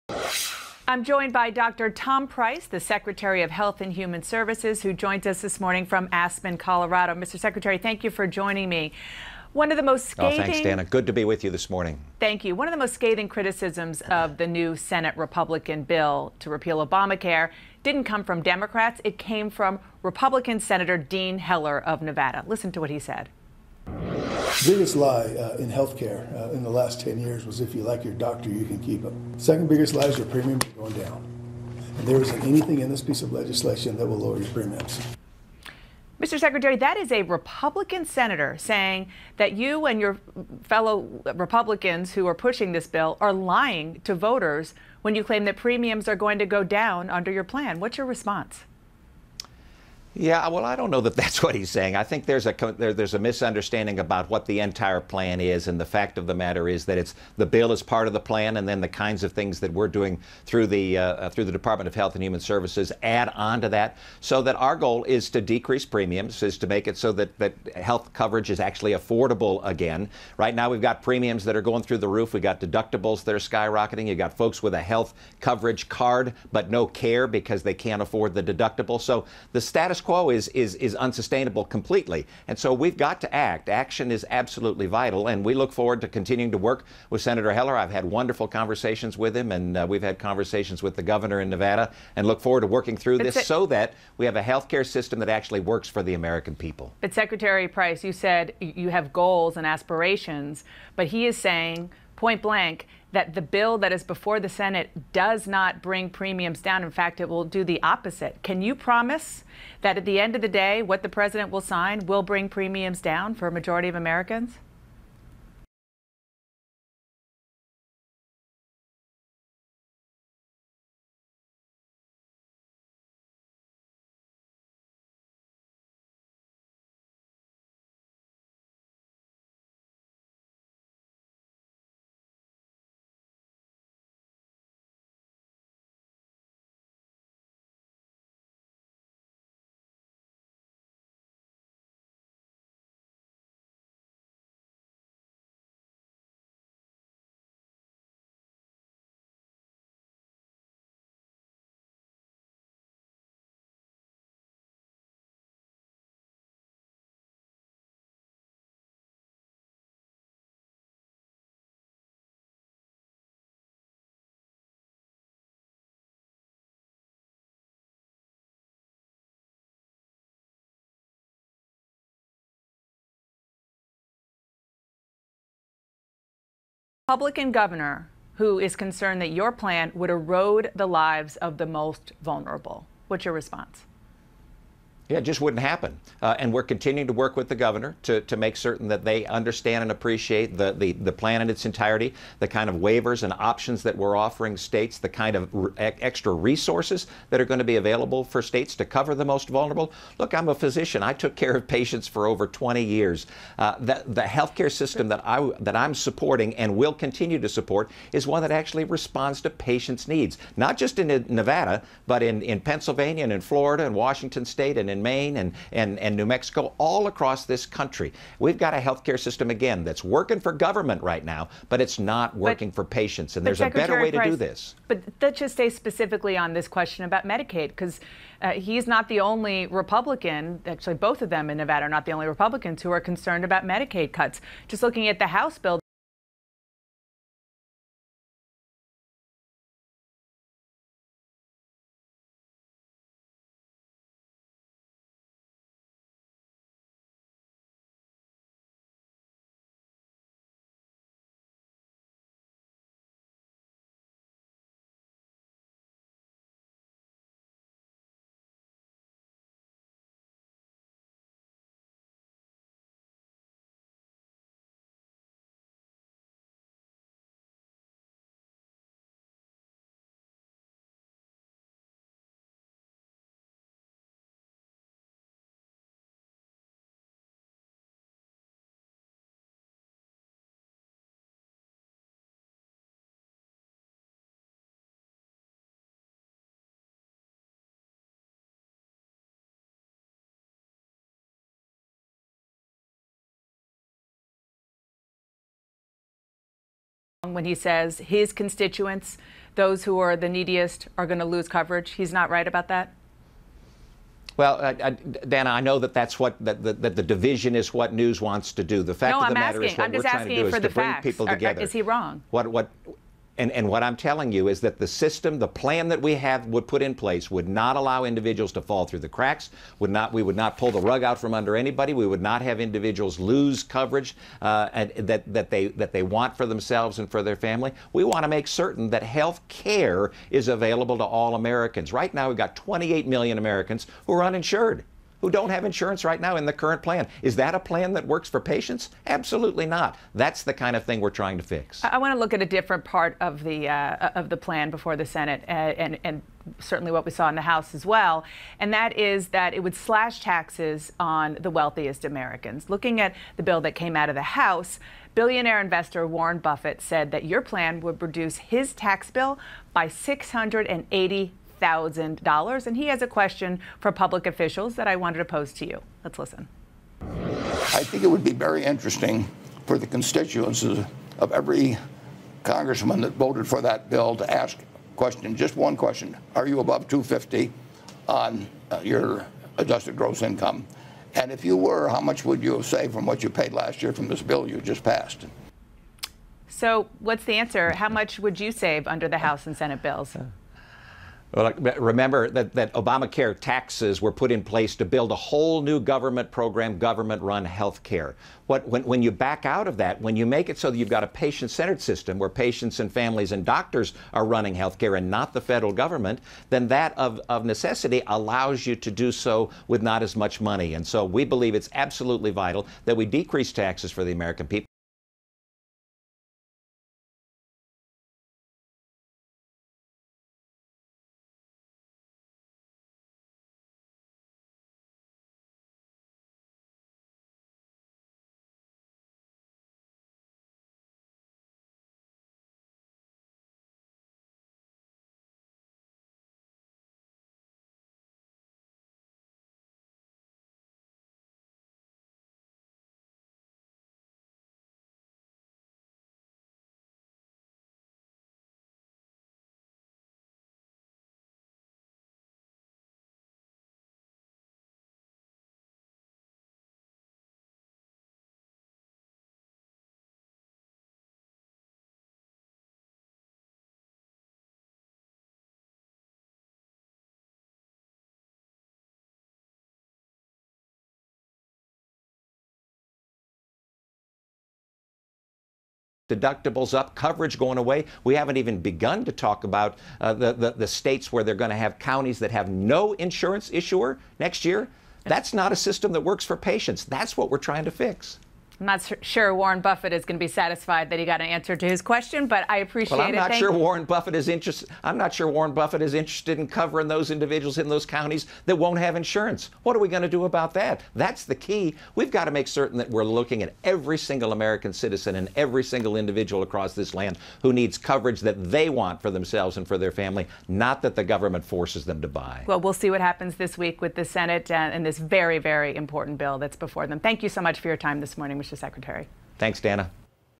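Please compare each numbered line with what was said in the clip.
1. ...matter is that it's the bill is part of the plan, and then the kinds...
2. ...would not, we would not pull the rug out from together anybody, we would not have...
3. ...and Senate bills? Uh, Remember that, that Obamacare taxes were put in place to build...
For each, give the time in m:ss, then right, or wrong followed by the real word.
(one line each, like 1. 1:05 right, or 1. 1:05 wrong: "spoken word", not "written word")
1. 0:56 right
2. 5:19 wrong: "under", not "together"
3. 6:29 right.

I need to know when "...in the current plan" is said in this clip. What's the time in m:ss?
5:36.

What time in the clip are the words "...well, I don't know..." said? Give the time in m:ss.
0:50.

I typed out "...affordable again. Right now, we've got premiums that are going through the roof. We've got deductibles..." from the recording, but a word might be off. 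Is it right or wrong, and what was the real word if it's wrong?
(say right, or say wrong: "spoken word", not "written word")
right.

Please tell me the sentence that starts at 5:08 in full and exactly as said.
The fact no, of the I'm matter asking, is what I'm we're trying to do is to bring facts.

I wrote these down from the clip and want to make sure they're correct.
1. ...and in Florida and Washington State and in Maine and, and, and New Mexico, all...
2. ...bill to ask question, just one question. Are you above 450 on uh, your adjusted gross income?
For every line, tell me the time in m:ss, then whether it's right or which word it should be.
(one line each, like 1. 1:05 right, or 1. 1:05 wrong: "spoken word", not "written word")
1. 3:33 right
2. 6:13 wrong: "250", not "450".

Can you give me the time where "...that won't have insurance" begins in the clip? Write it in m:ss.
8:18.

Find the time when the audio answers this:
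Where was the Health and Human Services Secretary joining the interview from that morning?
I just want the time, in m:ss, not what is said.
0:06.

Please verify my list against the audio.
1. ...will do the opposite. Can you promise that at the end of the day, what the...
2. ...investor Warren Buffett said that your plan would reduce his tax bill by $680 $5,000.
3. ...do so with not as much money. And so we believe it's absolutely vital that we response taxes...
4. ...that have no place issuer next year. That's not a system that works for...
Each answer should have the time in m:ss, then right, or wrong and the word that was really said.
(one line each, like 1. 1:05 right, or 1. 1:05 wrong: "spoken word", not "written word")
1. 1:47 right
2. 5:55 right
3. 6:48 wrong: "decrease", not "response"
4. 8:02 wrong: "insurance", not "place".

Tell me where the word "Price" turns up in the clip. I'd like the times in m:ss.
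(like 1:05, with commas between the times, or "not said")
0:02, 1:37, 3:44.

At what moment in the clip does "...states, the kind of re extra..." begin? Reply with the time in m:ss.
3:14.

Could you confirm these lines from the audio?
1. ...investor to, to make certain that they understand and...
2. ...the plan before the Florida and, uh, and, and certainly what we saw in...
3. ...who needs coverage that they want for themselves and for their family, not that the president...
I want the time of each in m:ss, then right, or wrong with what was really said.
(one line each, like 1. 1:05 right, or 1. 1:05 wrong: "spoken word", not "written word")
1. 3:07 wrong: "governor", not "investor"
2. 5:44 wrong: "Senate", not "Florida"
3. 8:27 wrong: "government", not "president".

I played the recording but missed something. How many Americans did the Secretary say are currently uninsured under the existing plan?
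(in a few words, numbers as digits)
28 million.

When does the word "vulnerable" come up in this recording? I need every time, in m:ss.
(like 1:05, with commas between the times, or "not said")
3:02, 3:19.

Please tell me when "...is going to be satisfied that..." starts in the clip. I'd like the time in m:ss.
8:09.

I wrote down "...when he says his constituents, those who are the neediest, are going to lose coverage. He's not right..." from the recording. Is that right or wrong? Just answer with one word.
right.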